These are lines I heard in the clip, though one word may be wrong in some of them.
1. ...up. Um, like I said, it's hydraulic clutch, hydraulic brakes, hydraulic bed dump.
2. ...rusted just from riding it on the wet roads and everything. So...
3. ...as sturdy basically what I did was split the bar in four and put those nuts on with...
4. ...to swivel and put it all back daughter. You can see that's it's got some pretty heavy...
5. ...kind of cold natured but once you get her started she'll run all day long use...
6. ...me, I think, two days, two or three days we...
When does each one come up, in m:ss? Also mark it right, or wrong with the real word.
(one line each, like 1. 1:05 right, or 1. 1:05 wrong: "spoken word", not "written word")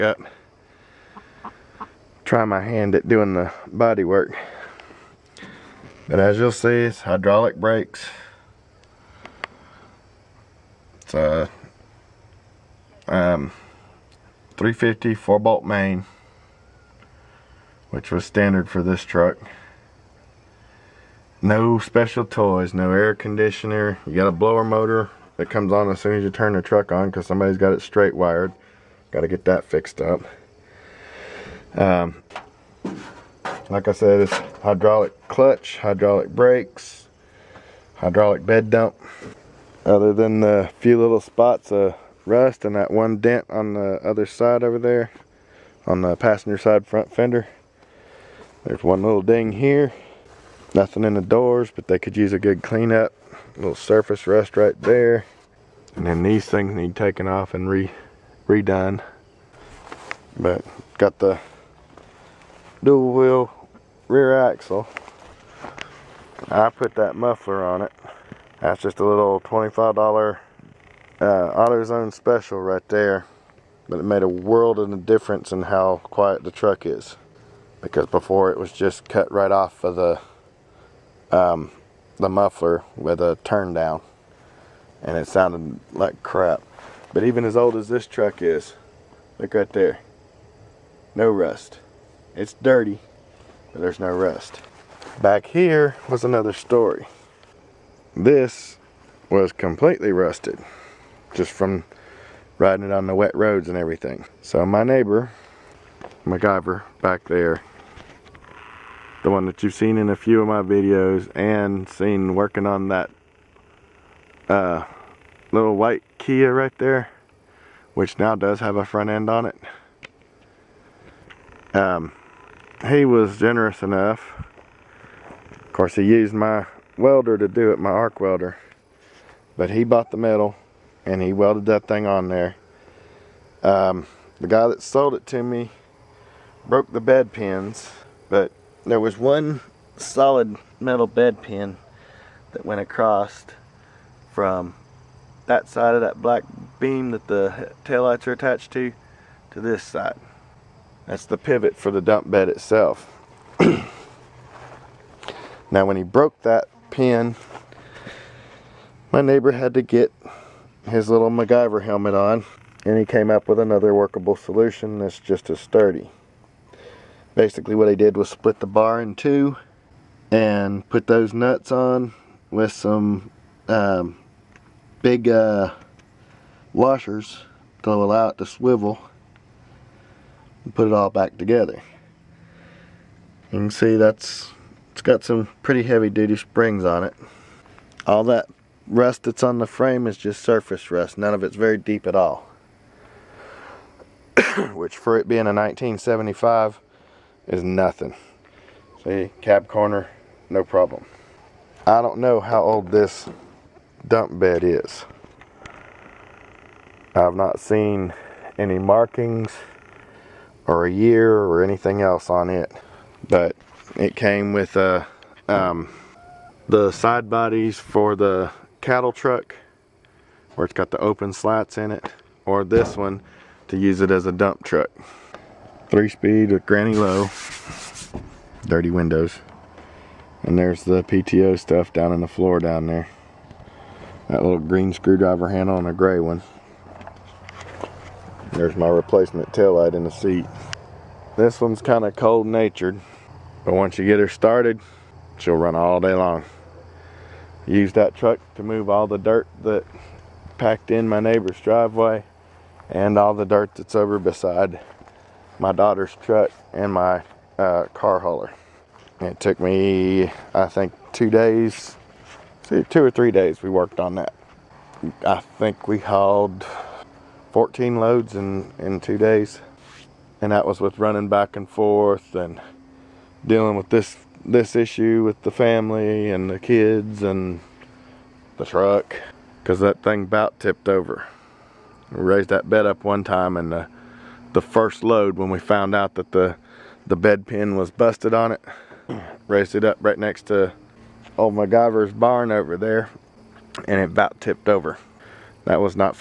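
1. 0:29 right
2. 1:40 right
3. 2:45 wrong: "two", not "four"
4. 2:58 wrong: "together", not "daughter"
5. 4:01 right
6. 4:19 right.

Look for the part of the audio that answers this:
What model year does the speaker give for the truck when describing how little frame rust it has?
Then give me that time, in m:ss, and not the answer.
3:15.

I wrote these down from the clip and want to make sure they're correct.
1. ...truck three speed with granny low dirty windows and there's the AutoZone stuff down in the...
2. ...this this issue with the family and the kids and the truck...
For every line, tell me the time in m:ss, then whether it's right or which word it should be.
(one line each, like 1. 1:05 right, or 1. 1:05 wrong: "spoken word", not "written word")
1. 3:44 wrong: "PTO", not "AutoZone"
2. 4:33 right.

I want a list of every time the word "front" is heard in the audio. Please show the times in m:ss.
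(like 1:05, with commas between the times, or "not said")
0:46, 1:58.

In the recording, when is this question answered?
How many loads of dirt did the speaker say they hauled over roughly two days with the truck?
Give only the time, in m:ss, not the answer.
4:27.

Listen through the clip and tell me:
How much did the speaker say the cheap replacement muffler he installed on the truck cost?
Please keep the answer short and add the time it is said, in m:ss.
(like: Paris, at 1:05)
$25, at 1:09.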